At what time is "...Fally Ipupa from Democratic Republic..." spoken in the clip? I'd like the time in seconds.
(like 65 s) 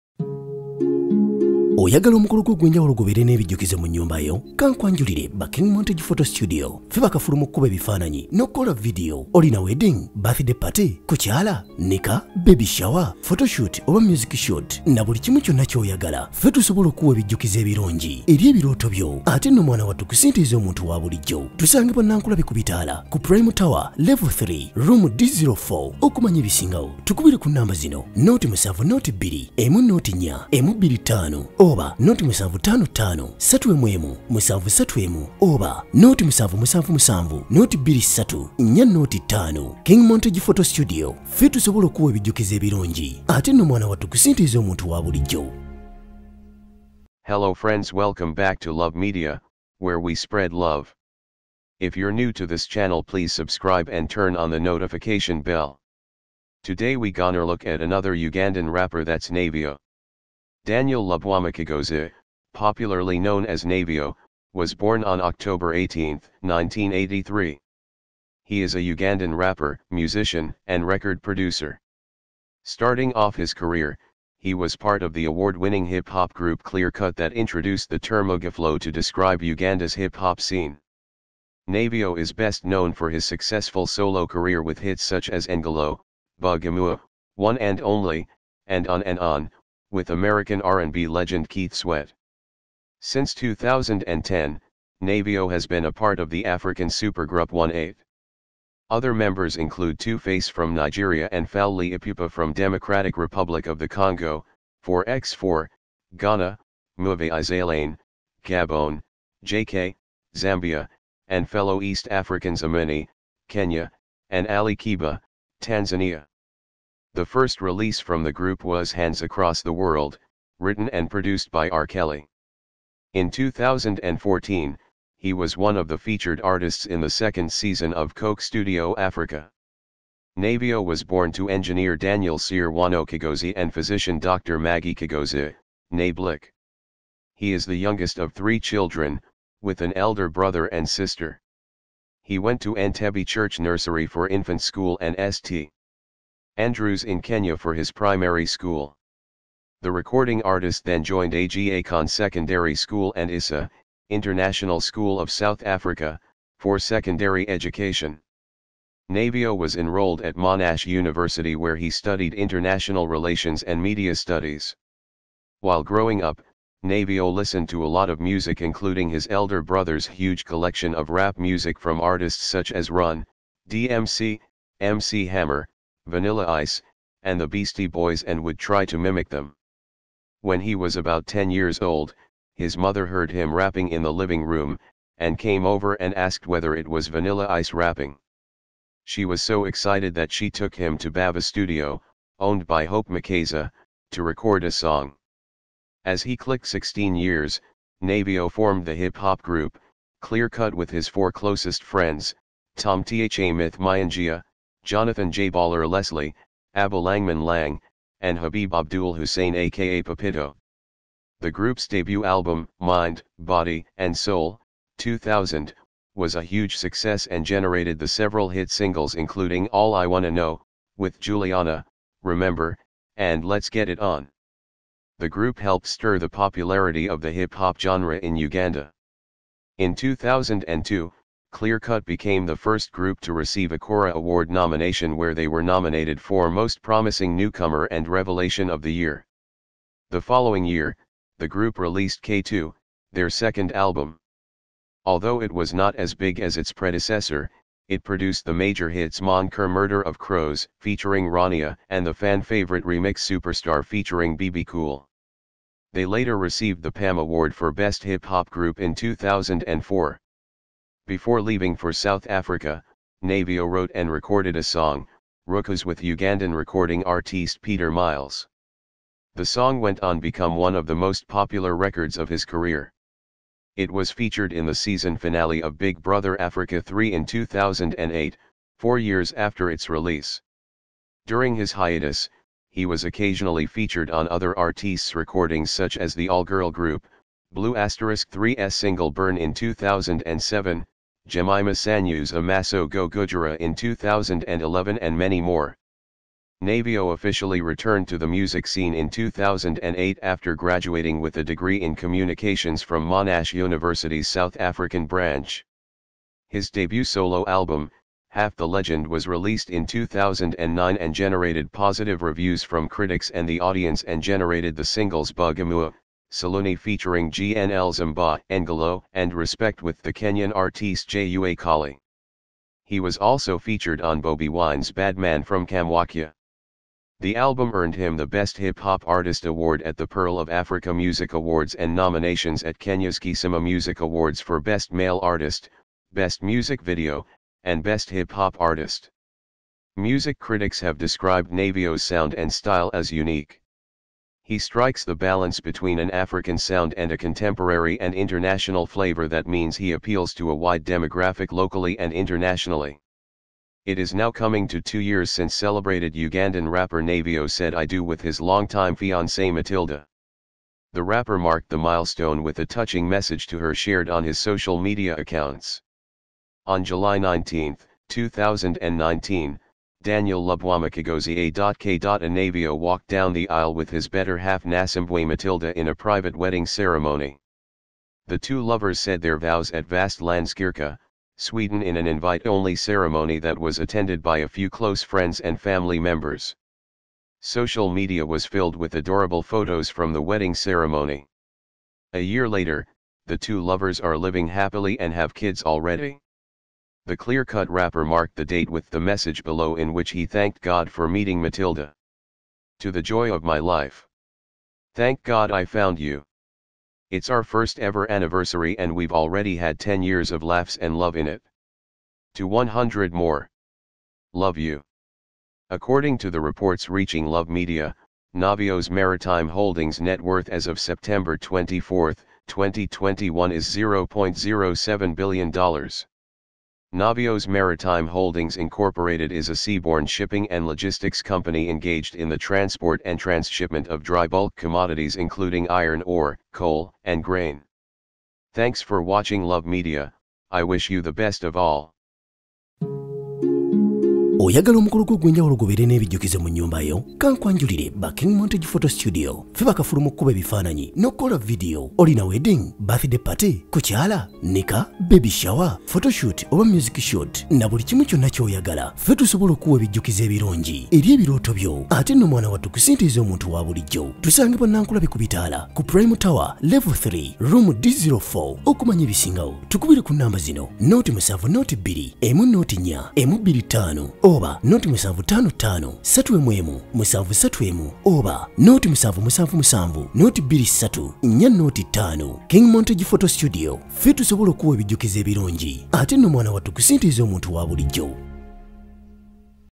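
101 s.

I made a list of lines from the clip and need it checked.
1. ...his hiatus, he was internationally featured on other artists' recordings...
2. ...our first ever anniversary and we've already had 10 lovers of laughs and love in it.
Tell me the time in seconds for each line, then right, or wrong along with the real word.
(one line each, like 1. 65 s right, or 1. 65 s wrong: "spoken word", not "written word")
1. 281 s wrong: "occasionally", not "internationally"
2. 407 s wrong: "years", not "lovers".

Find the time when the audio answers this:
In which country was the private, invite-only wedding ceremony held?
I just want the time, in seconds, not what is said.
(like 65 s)
381 s.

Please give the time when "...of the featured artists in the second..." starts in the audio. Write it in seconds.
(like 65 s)
125 s.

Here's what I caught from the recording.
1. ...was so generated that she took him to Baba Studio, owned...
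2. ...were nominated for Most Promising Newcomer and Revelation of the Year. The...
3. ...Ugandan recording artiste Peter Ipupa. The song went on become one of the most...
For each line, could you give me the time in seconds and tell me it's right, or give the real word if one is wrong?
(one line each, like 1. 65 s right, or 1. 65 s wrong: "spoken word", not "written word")
1. 189 s wrong: "excited", not "generated"
2. 235 s right
3. 265 s wrong: "Miles", not "Ipupa".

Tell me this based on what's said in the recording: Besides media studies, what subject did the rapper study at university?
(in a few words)
international relations.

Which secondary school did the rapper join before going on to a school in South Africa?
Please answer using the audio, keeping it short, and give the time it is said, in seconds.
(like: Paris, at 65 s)
Aga Khan Secondary School, at 151 s.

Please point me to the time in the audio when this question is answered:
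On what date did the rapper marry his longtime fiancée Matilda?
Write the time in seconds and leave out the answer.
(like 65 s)
366 s.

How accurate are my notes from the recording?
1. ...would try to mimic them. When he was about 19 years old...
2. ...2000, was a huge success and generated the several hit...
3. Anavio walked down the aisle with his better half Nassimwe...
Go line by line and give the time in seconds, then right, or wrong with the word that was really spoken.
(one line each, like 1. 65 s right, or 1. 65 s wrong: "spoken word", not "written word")
1. 178 s wrong: "10", not "19"
2. 214 s right
3. 370 s right.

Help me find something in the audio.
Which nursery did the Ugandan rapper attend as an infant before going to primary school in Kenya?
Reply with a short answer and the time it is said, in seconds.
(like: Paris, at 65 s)
Entebbe Church Nursery, at 142 s.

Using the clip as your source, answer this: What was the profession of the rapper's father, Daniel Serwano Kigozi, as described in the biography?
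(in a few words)
engineer.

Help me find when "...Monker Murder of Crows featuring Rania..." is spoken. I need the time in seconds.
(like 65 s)
249 s.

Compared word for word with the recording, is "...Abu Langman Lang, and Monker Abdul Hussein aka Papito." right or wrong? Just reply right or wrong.
wrong.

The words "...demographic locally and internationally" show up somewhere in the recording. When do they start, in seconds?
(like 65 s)
350 s.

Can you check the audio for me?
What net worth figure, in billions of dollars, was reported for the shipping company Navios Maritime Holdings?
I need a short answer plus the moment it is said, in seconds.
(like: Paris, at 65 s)
$0.07 billion, at 423 s.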